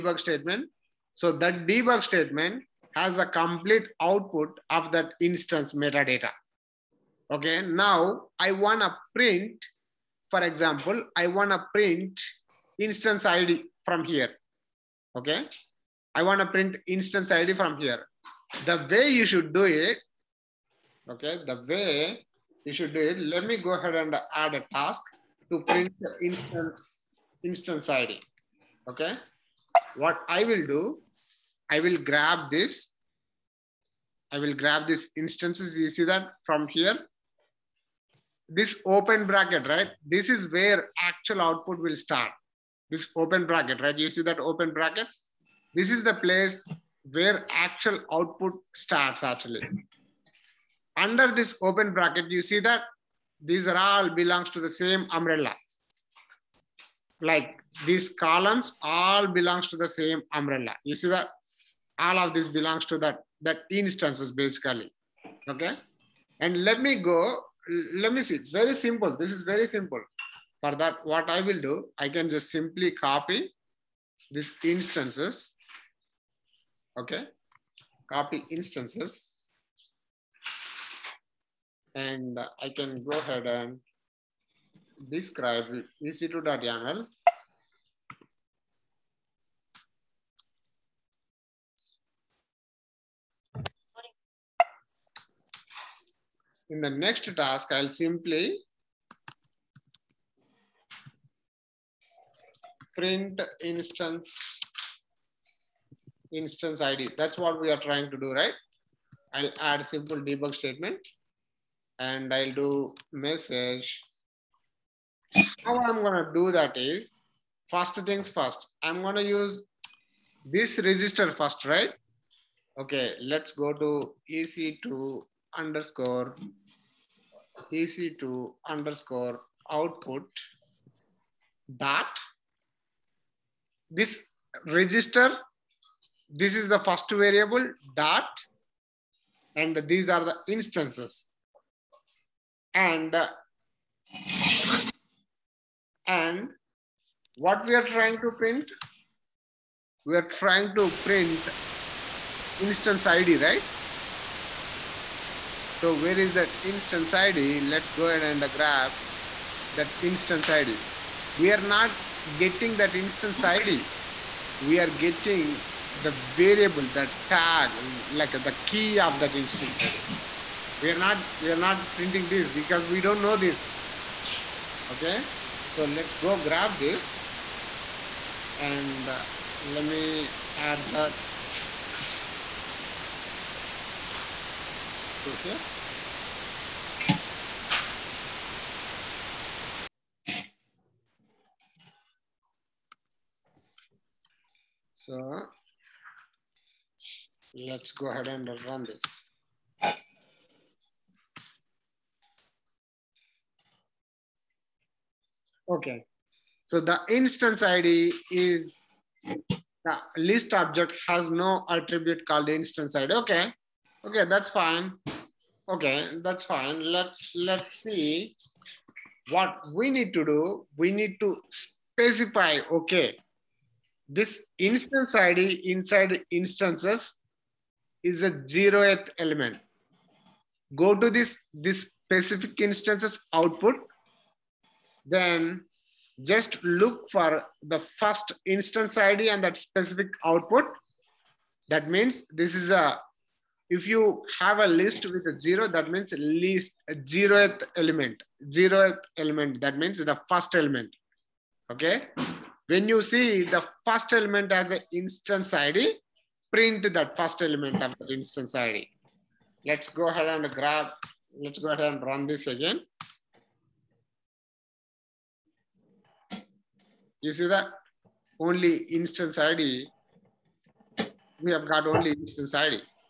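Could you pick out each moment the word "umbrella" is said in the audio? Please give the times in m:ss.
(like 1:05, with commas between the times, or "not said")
0:55, 1:00.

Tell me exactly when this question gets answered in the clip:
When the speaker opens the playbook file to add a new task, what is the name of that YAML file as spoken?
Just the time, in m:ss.
1:25.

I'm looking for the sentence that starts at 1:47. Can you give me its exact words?
That's what we are trying to do, right?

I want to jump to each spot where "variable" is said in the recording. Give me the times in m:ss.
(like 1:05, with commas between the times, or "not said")
2:17, 2:46.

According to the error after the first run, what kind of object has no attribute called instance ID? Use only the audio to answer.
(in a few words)
list object.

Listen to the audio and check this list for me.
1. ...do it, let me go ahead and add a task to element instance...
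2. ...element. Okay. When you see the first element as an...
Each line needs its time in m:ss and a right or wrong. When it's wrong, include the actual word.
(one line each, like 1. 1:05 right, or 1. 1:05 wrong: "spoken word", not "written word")
1. 0:22 wrong: "print", not "element"
2. 4:10 right.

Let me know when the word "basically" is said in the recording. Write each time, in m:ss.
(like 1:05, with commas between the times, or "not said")
1:04.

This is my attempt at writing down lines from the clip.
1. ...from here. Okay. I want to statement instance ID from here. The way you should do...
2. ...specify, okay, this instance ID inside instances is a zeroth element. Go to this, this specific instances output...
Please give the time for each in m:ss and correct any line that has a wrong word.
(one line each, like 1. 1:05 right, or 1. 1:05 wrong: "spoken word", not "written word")
1. 0:13 wrong: "print", not "statement"
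2. 3:41 right.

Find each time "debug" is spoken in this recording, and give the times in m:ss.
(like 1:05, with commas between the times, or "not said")
0:01, 1:50.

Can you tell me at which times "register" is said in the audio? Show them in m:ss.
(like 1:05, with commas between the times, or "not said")
2:00, 2:14.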